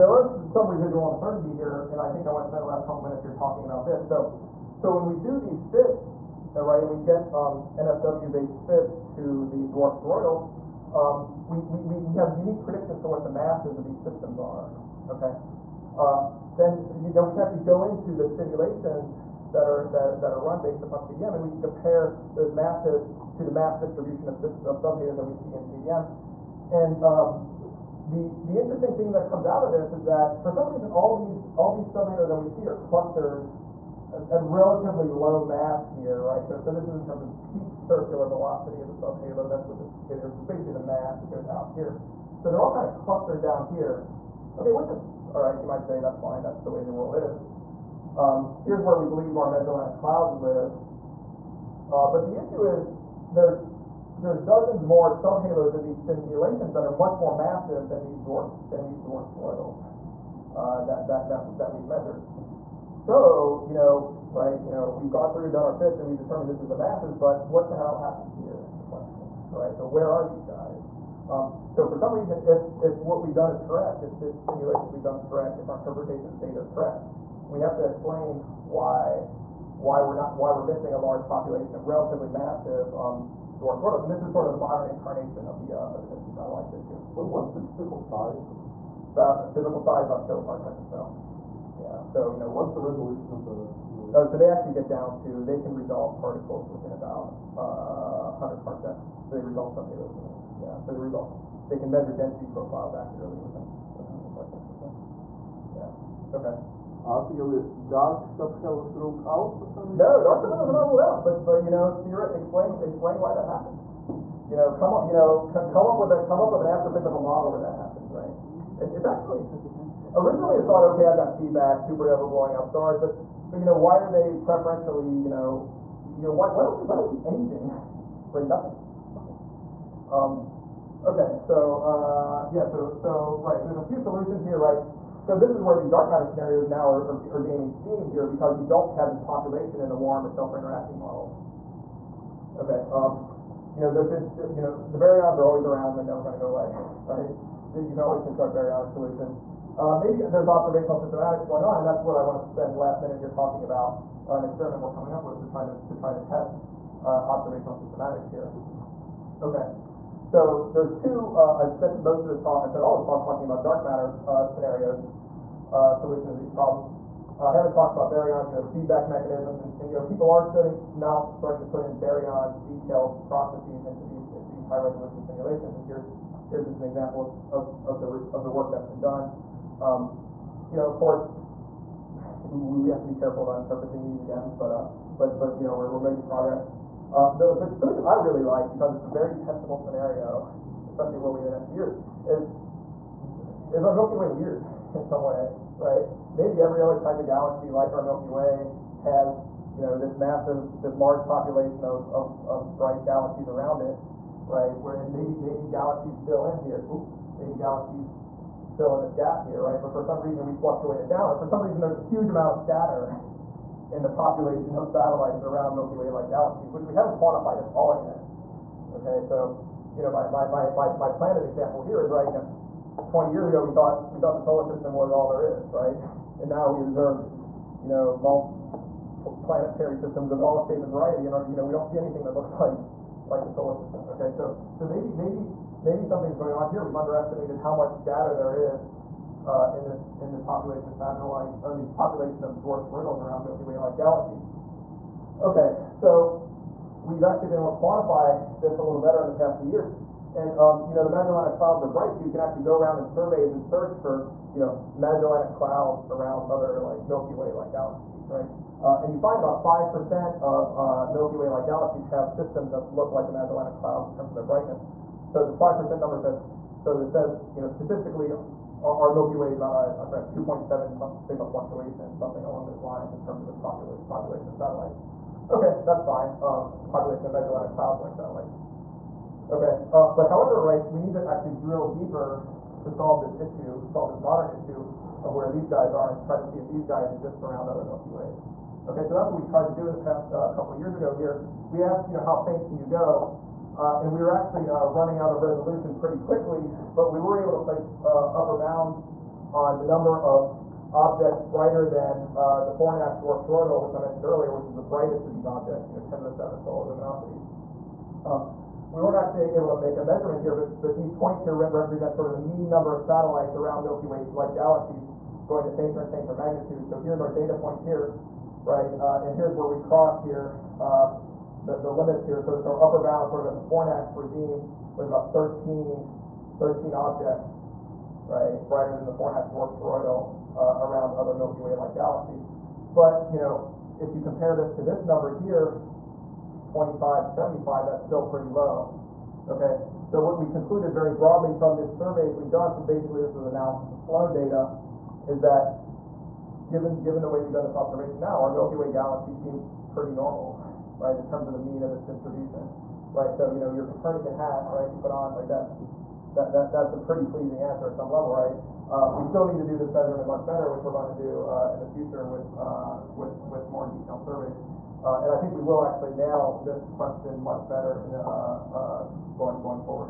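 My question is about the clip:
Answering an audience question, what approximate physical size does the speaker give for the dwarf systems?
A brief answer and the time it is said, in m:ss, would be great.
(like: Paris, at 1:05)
about a kiloparsec, at 1:30.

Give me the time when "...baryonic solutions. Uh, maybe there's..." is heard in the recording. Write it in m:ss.
2:28.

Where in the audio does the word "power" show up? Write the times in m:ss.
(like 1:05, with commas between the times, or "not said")
not said.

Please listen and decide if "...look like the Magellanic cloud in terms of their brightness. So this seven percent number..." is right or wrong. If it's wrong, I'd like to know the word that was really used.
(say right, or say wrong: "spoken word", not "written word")
wrong: "five", not "seven".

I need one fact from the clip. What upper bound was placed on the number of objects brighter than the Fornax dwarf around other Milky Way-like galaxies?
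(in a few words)
13.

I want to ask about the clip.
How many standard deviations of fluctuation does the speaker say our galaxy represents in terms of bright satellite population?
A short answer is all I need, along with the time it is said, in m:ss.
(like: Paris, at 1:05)
2.7 sigma, at 4:30.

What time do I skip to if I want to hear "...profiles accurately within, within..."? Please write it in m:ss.
1:42.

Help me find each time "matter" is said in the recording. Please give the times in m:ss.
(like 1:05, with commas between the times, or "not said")
2:16, 2:43.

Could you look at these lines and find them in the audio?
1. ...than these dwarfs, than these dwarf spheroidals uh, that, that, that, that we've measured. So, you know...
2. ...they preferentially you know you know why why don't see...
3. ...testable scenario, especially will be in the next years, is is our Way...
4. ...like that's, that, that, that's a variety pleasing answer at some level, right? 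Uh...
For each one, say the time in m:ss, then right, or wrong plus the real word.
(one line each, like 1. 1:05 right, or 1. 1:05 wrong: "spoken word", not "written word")
1. 0:57 right
2. 2:04 right
3. 3:09 wrong: "Milky", not "Way"
4. 5:55 wrong: "pretty", not "variety".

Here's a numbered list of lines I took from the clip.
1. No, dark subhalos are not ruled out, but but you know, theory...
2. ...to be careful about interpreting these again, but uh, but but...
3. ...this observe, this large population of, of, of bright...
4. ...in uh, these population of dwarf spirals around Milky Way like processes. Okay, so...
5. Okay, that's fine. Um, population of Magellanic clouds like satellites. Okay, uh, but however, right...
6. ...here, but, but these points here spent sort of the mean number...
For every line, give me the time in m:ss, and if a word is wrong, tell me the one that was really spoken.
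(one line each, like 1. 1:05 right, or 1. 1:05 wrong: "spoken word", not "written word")
1. 1:49 right
2. 3:02 right
3. 3:19 wrong: "massive", not "observe"
4. 4:01 wrong: "galaxies", not "processes"
5. 4:35 right
6. 5:10 wrong: "represent", not "spent".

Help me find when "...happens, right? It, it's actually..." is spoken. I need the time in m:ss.
1:57.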